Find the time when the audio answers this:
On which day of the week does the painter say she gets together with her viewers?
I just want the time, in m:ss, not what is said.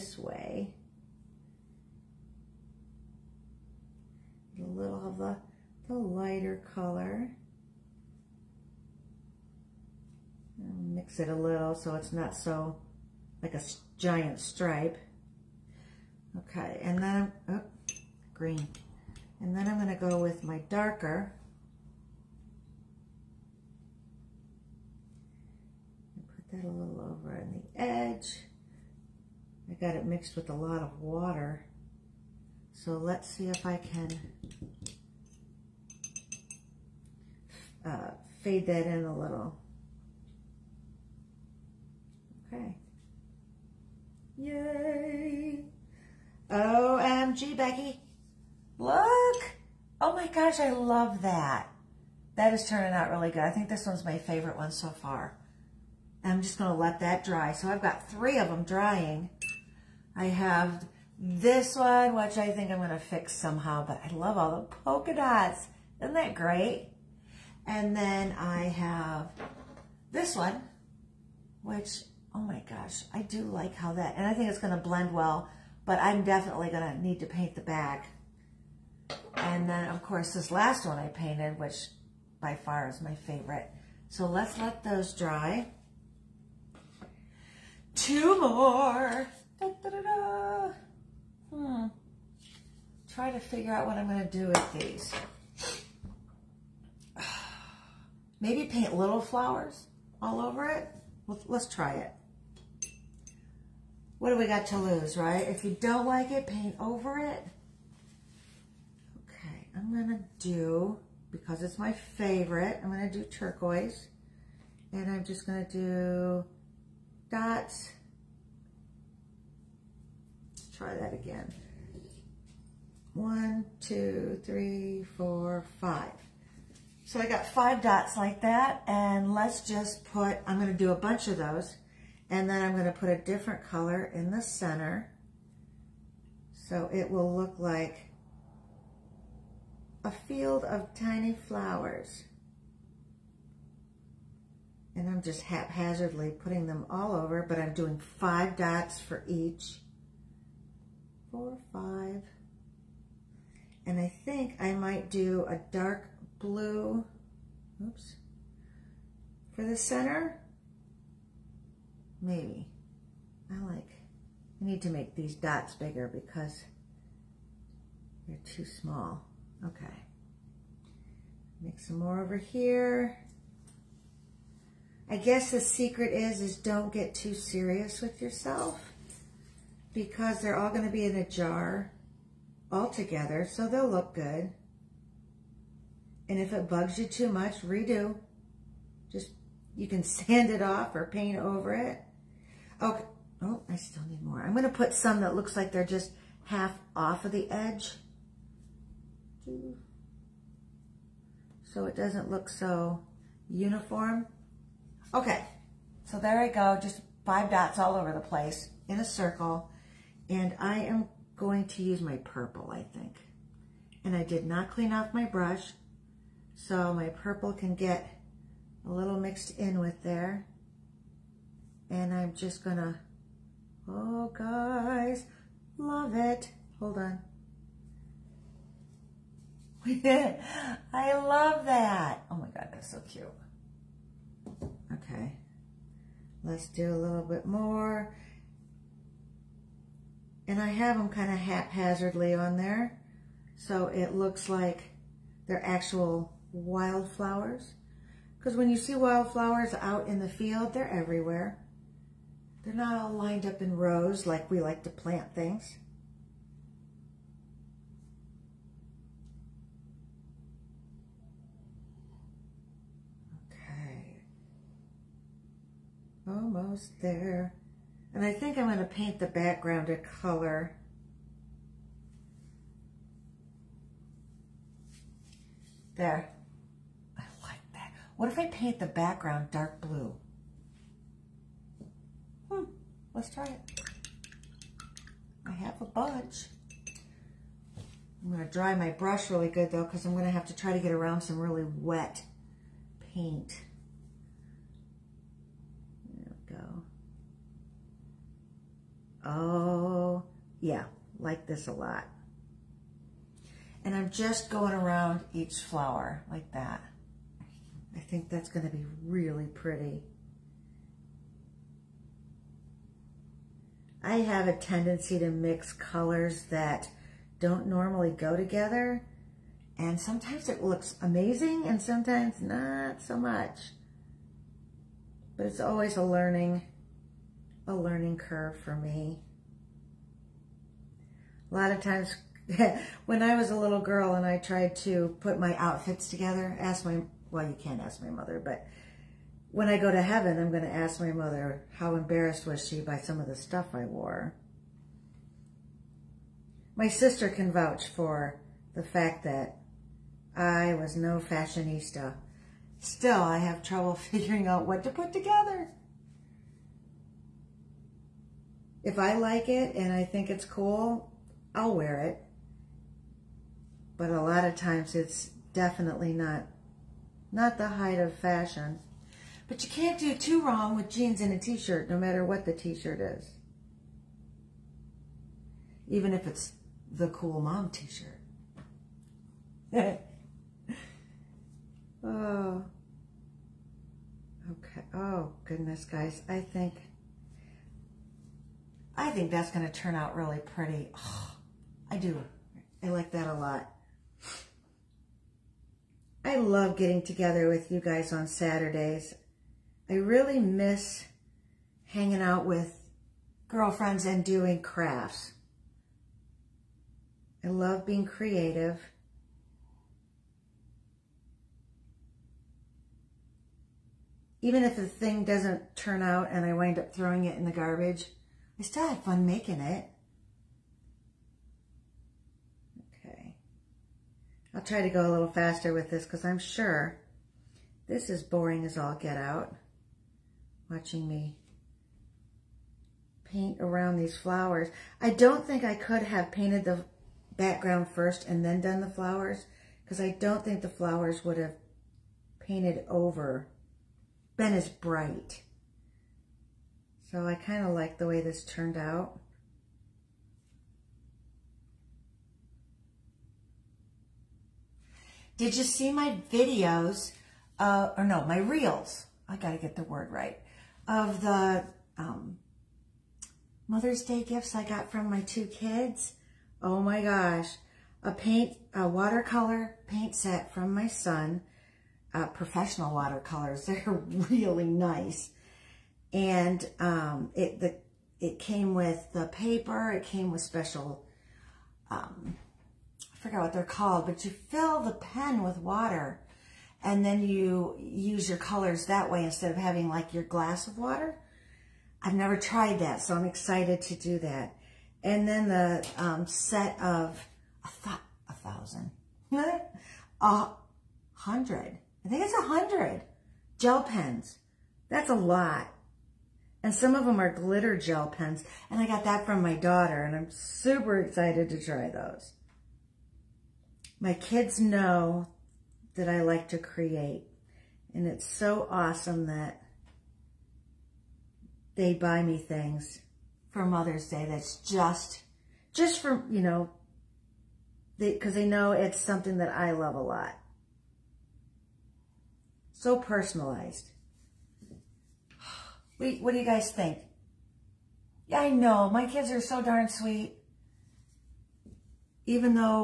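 6:38.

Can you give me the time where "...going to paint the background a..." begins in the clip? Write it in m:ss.
4:28.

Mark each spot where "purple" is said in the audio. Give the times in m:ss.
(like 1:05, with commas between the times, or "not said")
3:32, 3:37.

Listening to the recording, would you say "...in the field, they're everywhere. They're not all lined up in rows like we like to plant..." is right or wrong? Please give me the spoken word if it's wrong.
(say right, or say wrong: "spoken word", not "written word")
right.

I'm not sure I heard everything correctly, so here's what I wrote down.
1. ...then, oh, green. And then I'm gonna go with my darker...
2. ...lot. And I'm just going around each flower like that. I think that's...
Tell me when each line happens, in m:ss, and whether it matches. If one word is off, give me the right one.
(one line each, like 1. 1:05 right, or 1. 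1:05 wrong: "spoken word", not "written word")
1. 0:17 right
2. 5:01 right.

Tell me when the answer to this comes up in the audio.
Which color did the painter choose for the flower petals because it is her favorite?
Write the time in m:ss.
1:53.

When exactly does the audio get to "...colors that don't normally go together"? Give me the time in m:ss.
5:15.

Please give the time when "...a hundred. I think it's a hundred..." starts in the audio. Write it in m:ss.
8:20.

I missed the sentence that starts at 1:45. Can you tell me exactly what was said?
If you don't like it, paint over it.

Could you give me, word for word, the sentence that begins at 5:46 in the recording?
My sister can vouch for the fact that I was no fashionista.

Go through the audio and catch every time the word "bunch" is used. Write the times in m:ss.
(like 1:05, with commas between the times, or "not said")
2:10, 4:45.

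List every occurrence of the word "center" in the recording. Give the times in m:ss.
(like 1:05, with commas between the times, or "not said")
2:14, 2:39.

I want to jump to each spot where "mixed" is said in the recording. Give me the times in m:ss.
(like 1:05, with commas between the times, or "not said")
0:30, 3:39.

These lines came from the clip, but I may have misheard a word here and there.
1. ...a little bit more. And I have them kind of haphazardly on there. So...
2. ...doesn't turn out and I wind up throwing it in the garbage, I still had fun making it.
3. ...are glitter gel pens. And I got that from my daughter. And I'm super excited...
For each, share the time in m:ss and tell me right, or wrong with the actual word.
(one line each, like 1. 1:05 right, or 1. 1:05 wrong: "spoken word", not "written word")
1. 3:56 right
2. 6:55 right
3. 8:27 right.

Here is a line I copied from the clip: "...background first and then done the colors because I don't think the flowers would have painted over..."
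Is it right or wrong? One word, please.
wrong.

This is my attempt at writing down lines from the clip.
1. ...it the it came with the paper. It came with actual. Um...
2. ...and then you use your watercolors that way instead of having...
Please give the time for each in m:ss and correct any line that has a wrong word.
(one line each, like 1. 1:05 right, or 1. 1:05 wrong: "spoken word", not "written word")
1. 7:57 wrong: "special", not "actual"
2. 8:06 wrong: "colors", not "watercolors".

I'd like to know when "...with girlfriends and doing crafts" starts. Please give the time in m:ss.
6:42.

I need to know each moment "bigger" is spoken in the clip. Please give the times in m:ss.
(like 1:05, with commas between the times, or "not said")
2:45.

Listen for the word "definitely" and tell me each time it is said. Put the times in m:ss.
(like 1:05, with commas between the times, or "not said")
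1:16, 6:05.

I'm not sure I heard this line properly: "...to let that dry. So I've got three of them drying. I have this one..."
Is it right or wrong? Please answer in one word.
right.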